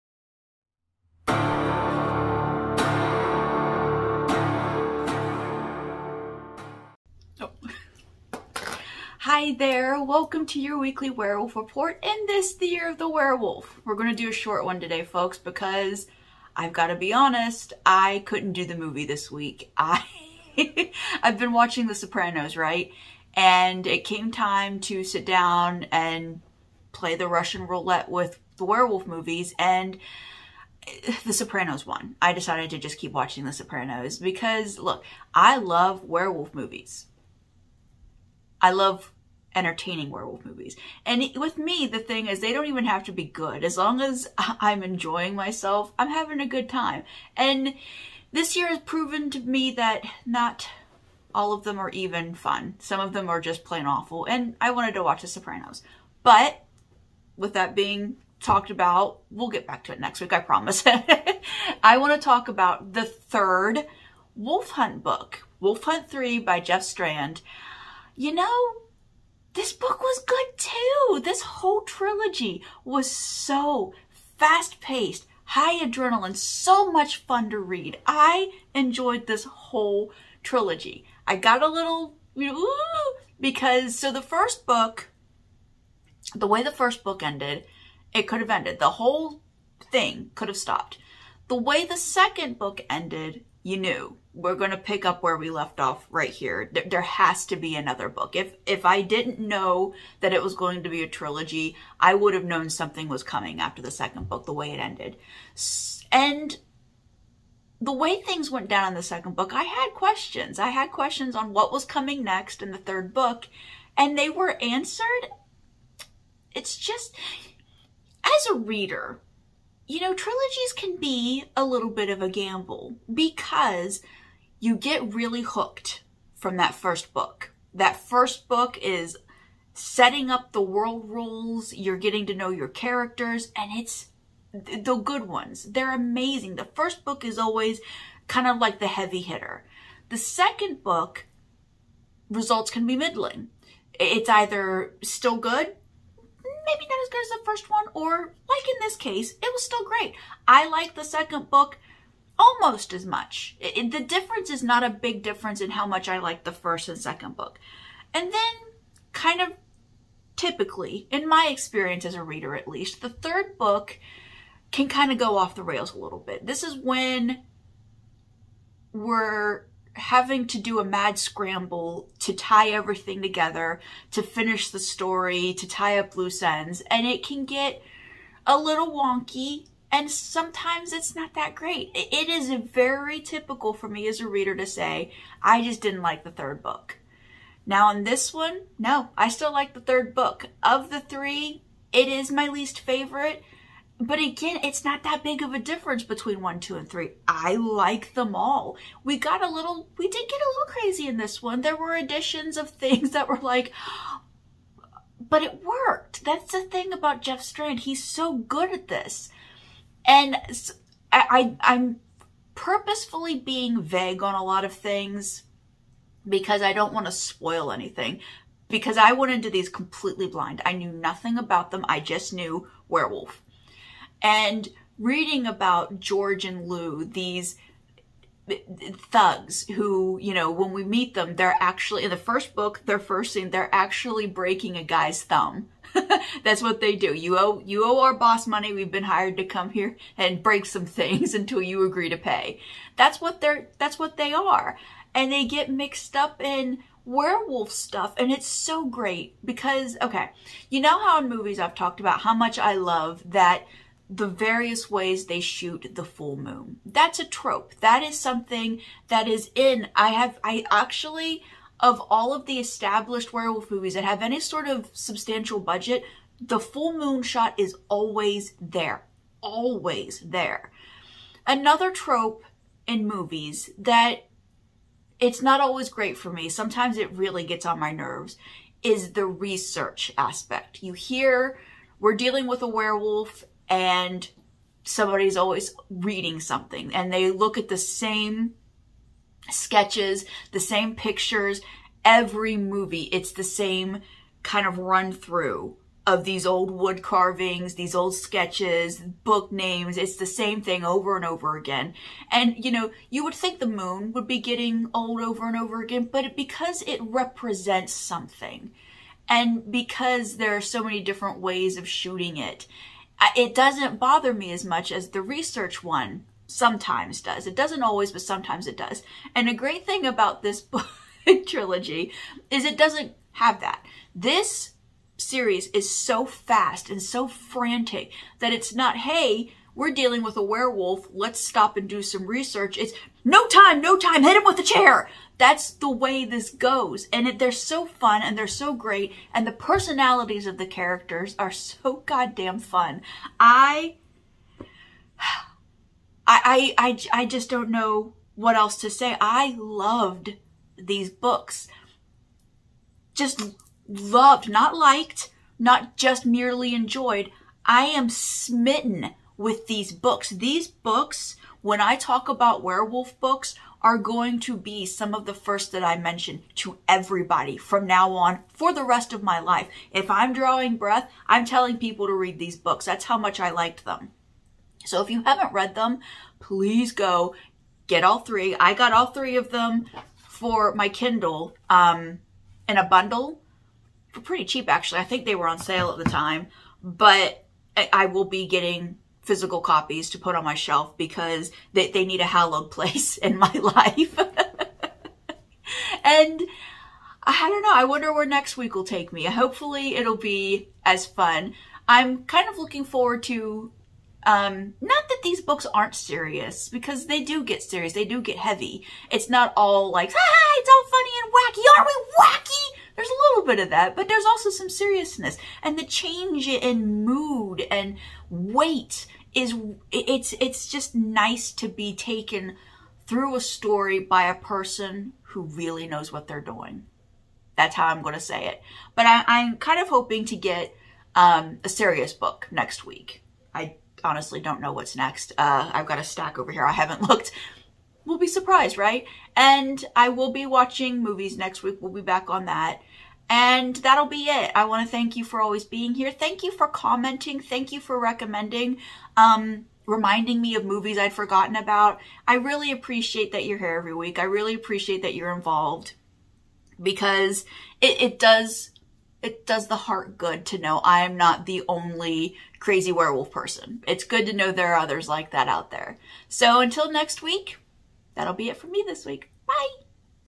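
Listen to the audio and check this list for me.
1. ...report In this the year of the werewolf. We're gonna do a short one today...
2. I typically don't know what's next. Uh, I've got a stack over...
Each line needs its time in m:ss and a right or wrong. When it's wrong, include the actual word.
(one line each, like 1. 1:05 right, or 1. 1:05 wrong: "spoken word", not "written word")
1. 0:11 right
2. 7:13 wrong: "honestly", not "typically".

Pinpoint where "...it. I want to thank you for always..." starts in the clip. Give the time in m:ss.
7:24.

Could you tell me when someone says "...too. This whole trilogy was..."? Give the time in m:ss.
1:10.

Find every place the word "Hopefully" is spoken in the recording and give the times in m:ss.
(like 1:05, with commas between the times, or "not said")
6:39.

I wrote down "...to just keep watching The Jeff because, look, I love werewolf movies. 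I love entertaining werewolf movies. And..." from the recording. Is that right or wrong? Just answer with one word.
wrong.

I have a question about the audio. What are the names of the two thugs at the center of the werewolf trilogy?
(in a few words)
George and Lou.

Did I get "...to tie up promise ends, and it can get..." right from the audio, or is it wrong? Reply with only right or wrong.
wrong.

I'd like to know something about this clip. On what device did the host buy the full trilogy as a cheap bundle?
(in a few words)
Kindle.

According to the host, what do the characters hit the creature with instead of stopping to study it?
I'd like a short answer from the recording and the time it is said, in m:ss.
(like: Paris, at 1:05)
a chair, at 5:34.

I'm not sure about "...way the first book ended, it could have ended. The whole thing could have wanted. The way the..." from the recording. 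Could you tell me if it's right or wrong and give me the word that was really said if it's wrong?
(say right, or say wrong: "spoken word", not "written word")
wrong: "stopped", not "wanted".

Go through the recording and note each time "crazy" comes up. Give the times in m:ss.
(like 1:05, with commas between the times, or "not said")
3:20, 7:42.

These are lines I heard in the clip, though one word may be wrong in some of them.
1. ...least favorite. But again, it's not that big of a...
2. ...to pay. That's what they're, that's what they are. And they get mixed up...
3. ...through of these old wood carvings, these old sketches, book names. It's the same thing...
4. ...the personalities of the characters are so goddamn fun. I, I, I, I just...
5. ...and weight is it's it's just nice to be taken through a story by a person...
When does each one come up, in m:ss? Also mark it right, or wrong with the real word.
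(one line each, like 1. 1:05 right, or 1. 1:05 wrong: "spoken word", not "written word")
1. 3:12 right
2. 4:02 right
3. 4:55 right
4. 5:39 right
5. 6:57 right.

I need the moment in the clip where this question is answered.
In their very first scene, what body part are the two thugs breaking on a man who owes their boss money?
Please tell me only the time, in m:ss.
3:55.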